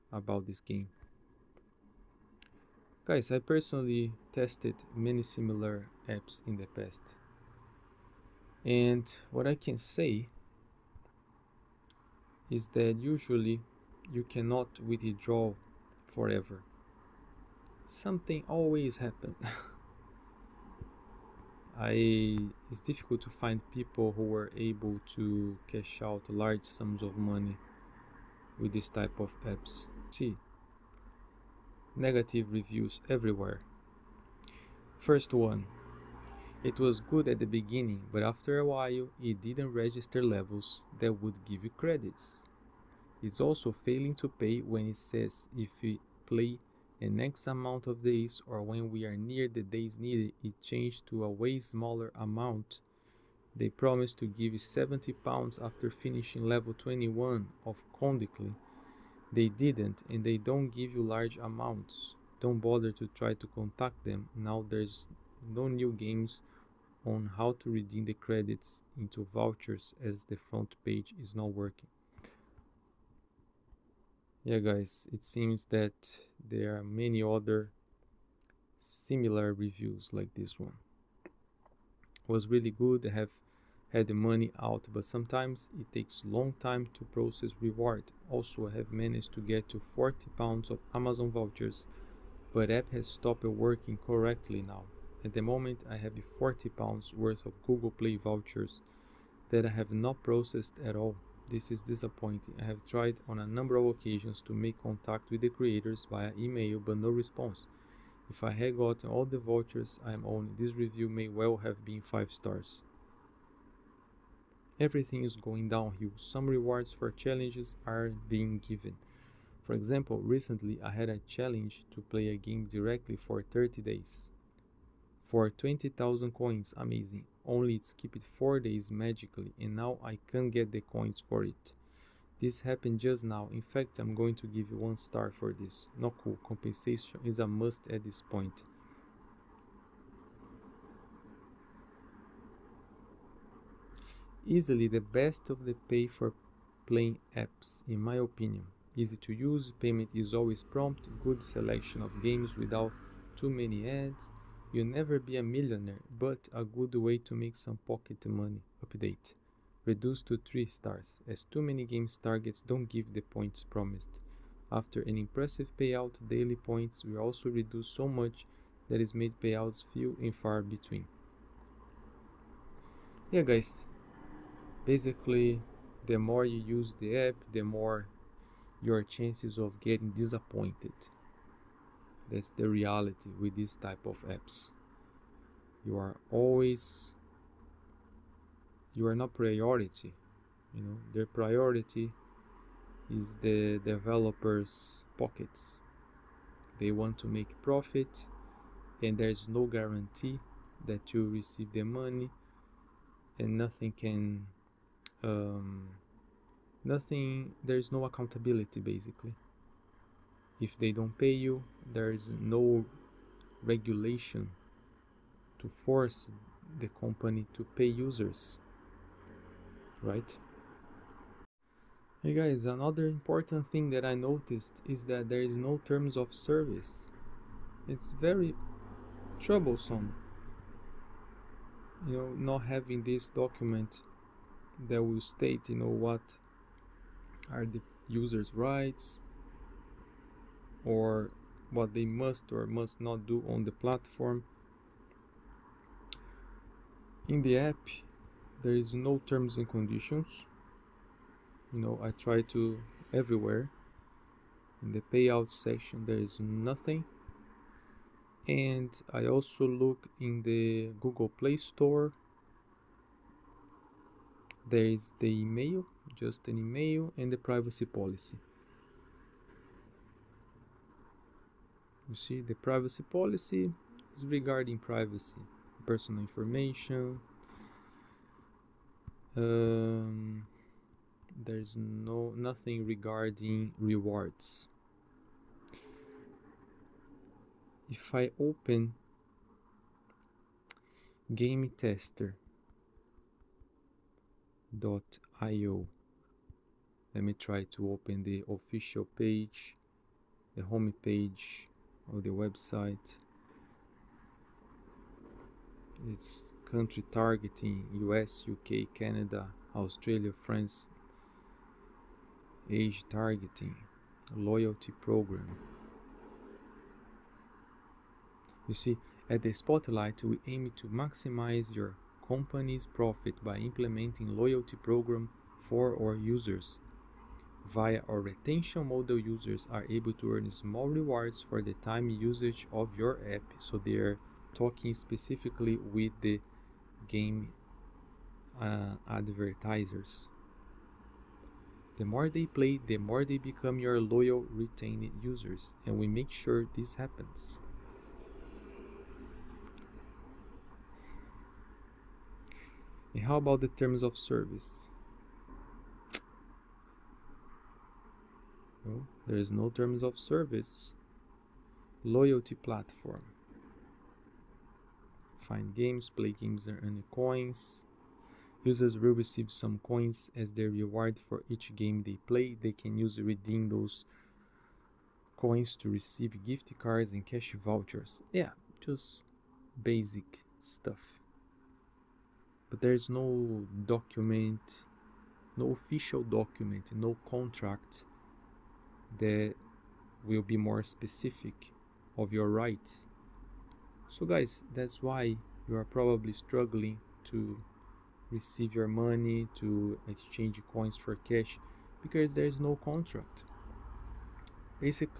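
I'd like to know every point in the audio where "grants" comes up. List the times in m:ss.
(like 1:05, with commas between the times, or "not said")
not said.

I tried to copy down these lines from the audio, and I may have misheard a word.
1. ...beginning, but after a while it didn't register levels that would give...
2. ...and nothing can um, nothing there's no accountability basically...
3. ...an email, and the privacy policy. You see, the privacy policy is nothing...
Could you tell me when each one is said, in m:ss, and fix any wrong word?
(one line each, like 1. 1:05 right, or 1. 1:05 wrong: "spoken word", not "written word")
1. 0:37 right
2. 3:23 right
3. 4:26 wrong: "regarding", not "nothing".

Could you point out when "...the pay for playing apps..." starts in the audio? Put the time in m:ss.
2:25.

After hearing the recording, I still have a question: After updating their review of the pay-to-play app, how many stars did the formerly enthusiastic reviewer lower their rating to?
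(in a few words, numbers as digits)
3 stars.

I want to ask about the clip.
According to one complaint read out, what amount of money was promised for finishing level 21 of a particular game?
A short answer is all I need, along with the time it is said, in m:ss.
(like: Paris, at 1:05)
70 pounds, at 0:54.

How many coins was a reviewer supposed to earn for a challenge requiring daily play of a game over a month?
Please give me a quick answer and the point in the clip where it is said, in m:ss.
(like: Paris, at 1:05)
20,000 coins, at 2:05.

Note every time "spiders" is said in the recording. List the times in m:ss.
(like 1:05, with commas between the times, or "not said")
not said.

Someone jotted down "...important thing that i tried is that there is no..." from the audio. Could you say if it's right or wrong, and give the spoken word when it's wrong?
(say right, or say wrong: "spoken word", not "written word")
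wrong: "noticed", not "tried".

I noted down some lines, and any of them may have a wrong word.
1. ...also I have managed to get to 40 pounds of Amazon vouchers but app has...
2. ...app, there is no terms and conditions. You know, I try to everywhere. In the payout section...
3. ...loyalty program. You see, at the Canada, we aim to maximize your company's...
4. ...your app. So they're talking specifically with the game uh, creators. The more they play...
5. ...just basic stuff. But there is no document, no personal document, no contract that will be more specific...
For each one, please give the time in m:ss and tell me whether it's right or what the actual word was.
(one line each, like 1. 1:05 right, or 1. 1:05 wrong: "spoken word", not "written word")
1. 1:28 right
2. 4:07 right
3. 5:14 wrong: "Spotlight", not "Canada"
4. 5:32 wrong: "advertisers", not "creators"
5. 6:18 wrong: "official", not "personal".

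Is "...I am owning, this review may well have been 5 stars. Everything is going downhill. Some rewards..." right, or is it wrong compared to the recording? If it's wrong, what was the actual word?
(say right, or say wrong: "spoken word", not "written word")
right.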